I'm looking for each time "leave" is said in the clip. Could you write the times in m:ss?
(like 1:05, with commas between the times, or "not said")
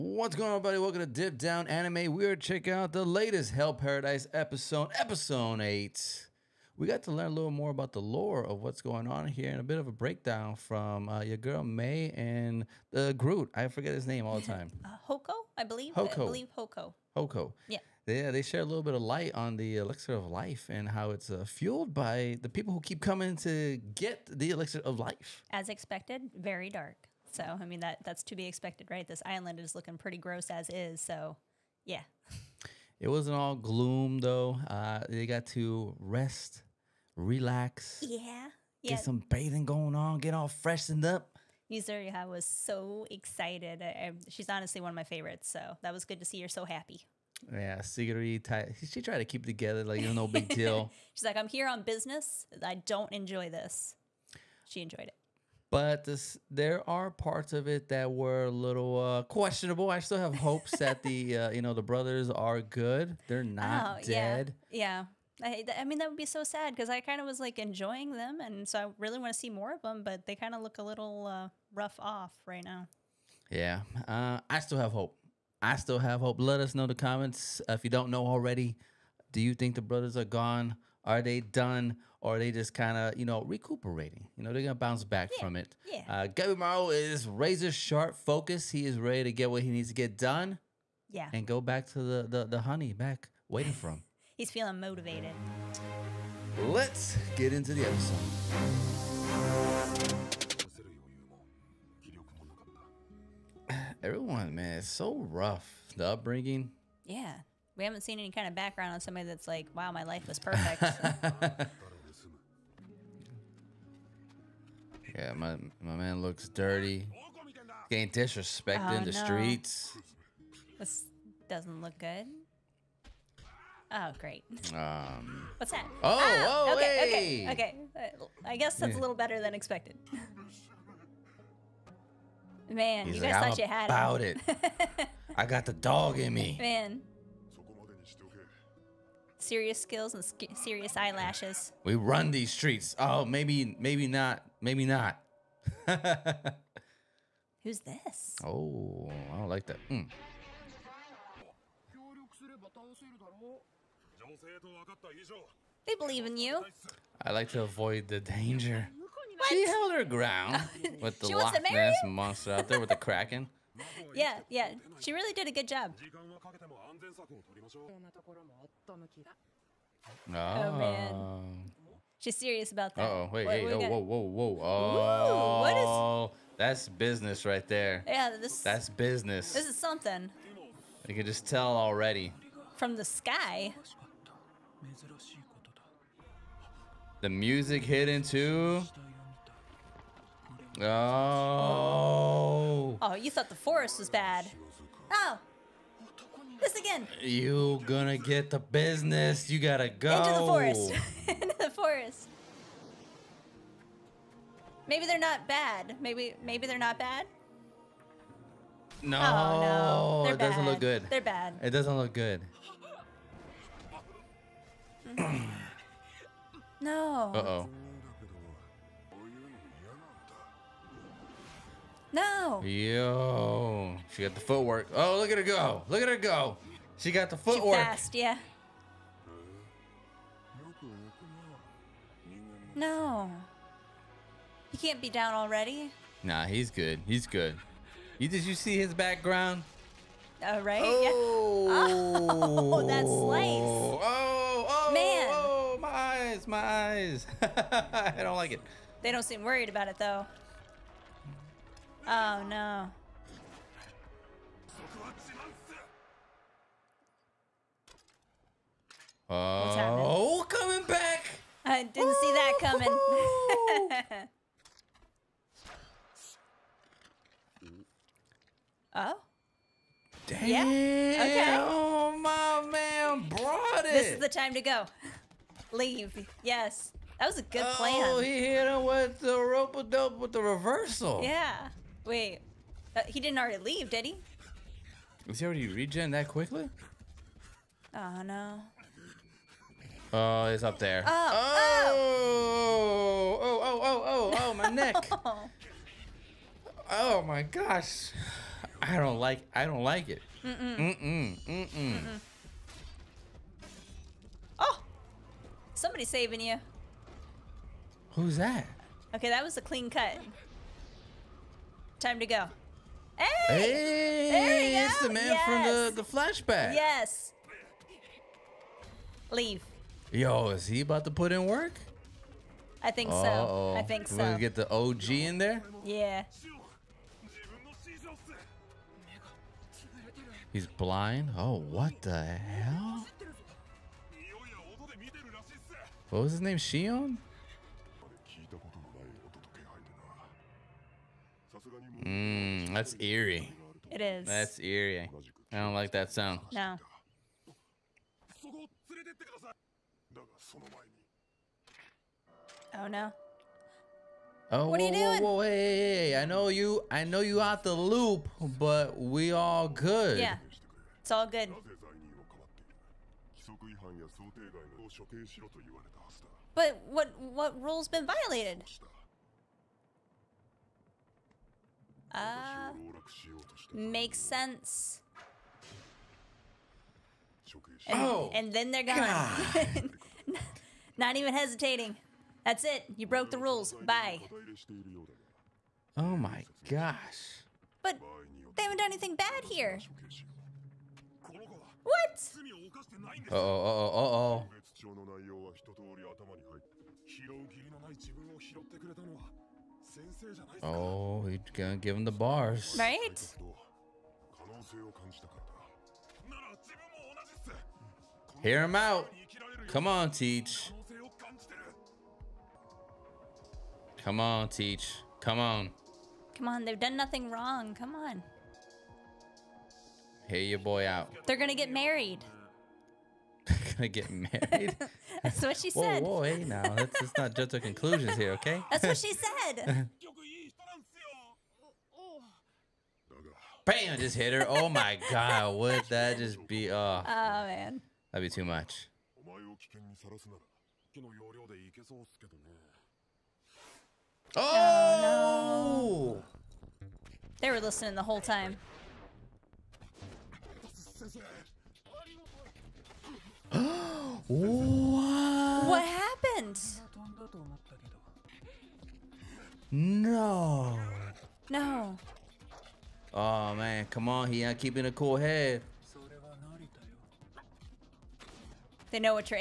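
4:35, 4:43, 5:19.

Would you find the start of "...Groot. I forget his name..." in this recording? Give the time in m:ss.
0:13.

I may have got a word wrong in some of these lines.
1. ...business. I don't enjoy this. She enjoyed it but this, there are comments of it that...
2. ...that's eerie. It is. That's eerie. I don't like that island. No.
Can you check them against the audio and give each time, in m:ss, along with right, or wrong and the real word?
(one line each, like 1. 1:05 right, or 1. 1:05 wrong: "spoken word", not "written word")
1. 0:51 wrong: "parts", not "comments"
2. 5:42 wrong: "sound", not "island".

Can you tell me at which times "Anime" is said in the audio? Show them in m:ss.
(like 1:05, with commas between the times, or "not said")
0:01.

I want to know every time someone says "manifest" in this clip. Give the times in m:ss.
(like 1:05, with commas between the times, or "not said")
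not said.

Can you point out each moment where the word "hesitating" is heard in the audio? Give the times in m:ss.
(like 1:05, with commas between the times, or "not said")
6:21.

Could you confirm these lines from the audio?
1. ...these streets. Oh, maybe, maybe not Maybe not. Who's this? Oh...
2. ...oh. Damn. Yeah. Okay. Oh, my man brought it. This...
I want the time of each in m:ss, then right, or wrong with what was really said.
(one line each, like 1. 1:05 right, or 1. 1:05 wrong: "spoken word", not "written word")
1. 2:22 right
2. 4:28 right.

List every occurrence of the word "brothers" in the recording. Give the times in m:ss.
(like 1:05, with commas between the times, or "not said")
1:01, 1:19.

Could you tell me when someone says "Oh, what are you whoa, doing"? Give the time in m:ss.
5:54.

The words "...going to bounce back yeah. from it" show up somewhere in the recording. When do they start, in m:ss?
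1:24.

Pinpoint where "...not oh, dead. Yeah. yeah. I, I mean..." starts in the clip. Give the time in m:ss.
1:03.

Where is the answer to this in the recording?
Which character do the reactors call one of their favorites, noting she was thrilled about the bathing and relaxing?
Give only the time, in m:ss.
0:41.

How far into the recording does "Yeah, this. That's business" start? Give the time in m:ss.
2:58.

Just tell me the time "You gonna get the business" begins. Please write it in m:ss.
3:17.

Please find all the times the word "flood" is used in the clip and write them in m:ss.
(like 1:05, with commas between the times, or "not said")
not said.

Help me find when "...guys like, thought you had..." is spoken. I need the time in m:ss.
2:13.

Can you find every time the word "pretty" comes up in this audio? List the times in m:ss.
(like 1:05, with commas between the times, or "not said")
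0:29.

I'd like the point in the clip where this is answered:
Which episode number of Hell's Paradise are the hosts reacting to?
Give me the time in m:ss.
0:04.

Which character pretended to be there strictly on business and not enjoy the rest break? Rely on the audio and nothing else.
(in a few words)
Sagiri.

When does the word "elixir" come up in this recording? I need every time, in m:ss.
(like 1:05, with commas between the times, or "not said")
0:19, 0:24.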